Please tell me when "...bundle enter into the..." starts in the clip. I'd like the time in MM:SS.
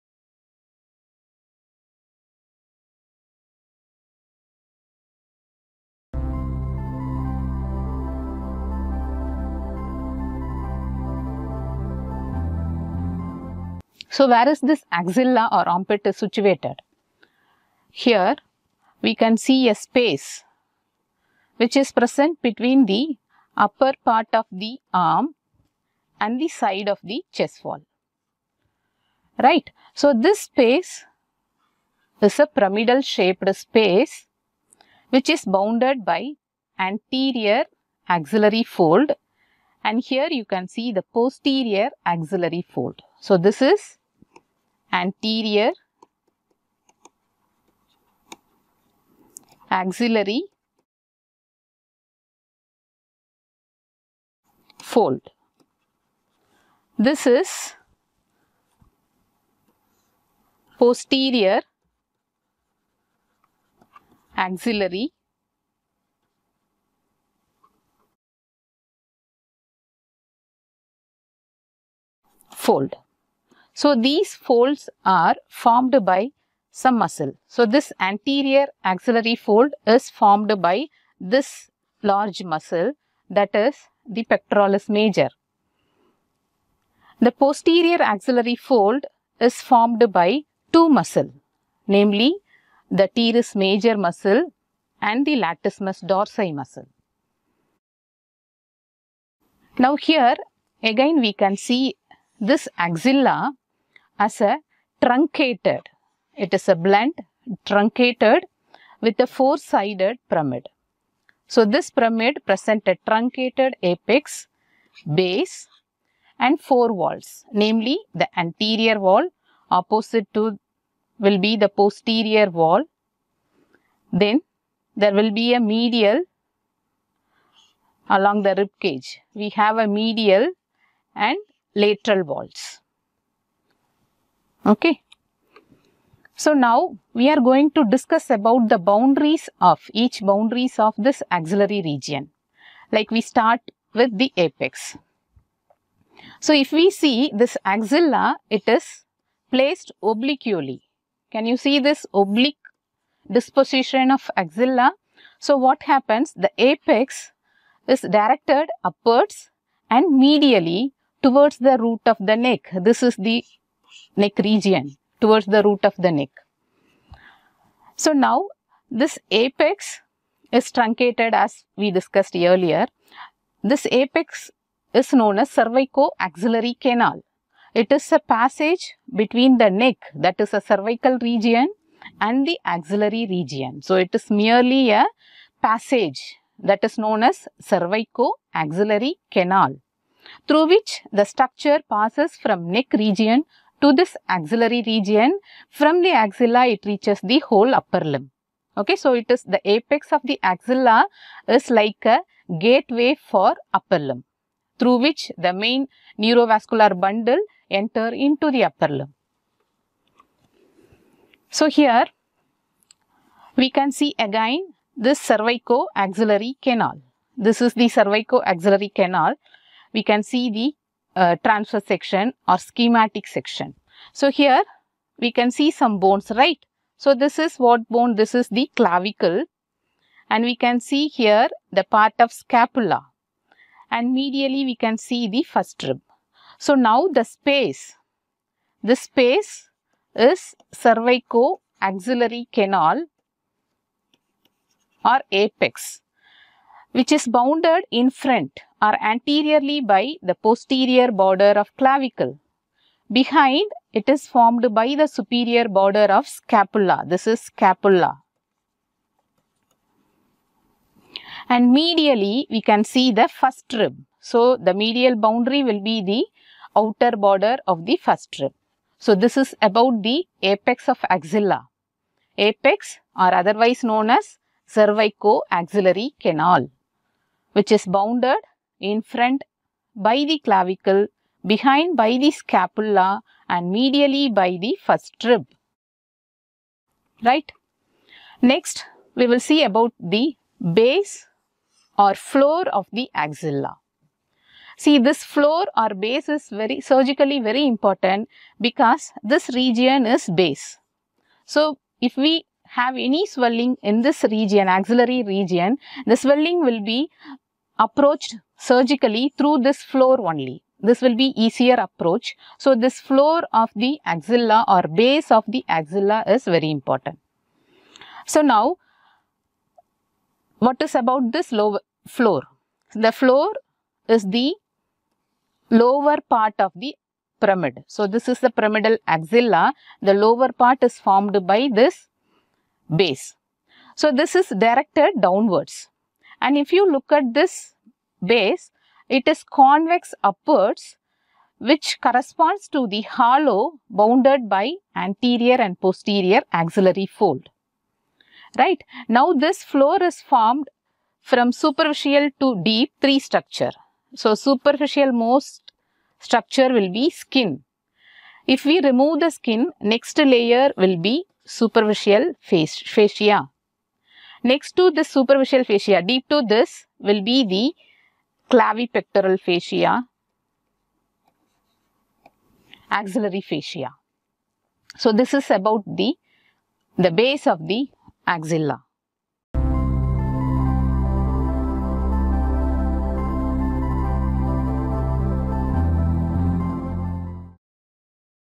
03:26.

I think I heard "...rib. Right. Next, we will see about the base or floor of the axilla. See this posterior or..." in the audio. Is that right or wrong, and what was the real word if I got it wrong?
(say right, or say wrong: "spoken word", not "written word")
wrong: "floor", not "posterior".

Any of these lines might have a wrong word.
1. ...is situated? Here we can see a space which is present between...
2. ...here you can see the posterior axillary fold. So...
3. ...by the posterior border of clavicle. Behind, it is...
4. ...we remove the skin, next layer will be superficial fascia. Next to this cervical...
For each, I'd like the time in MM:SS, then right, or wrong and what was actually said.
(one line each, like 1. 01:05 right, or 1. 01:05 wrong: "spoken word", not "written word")
1. 00:16 right
2. 00:40 right
3. 04:09 right
4. 05:58 wrong: "superficial", not "cervical".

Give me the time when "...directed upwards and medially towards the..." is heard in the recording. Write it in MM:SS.
02:38.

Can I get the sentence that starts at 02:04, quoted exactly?
Then there will be a medial along the rib cage.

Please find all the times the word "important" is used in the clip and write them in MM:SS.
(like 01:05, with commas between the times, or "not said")
04:57, 05:16.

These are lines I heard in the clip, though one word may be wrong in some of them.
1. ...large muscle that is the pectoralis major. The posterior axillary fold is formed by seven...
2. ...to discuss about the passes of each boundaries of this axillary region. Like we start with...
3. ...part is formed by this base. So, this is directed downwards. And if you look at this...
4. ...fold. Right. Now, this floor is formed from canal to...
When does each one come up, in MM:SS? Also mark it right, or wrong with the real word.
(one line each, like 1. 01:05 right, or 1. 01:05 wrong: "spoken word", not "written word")
1. 01:22 wrong: "two", not "seven"
2. 02:17 wrong: "boundaries", not "passes"
3. 05:30 right
4. 05:47 wrong: "superficial", not "canal".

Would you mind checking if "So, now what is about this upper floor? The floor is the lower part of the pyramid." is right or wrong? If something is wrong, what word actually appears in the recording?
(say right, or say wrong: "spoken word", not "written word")
wrong: "lower", not "upper".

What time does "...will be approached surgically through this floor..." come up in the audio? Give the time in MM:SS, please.
05:06.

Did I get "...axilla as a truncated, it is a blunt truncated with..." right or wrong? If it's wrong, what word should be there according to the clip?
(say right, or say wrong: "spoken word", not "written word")
right.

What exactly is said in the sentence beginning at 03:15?
From the axilla, it reaches the whole upper limb.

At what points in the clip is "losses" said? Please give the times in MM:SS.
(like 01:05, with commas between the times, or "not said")
not said.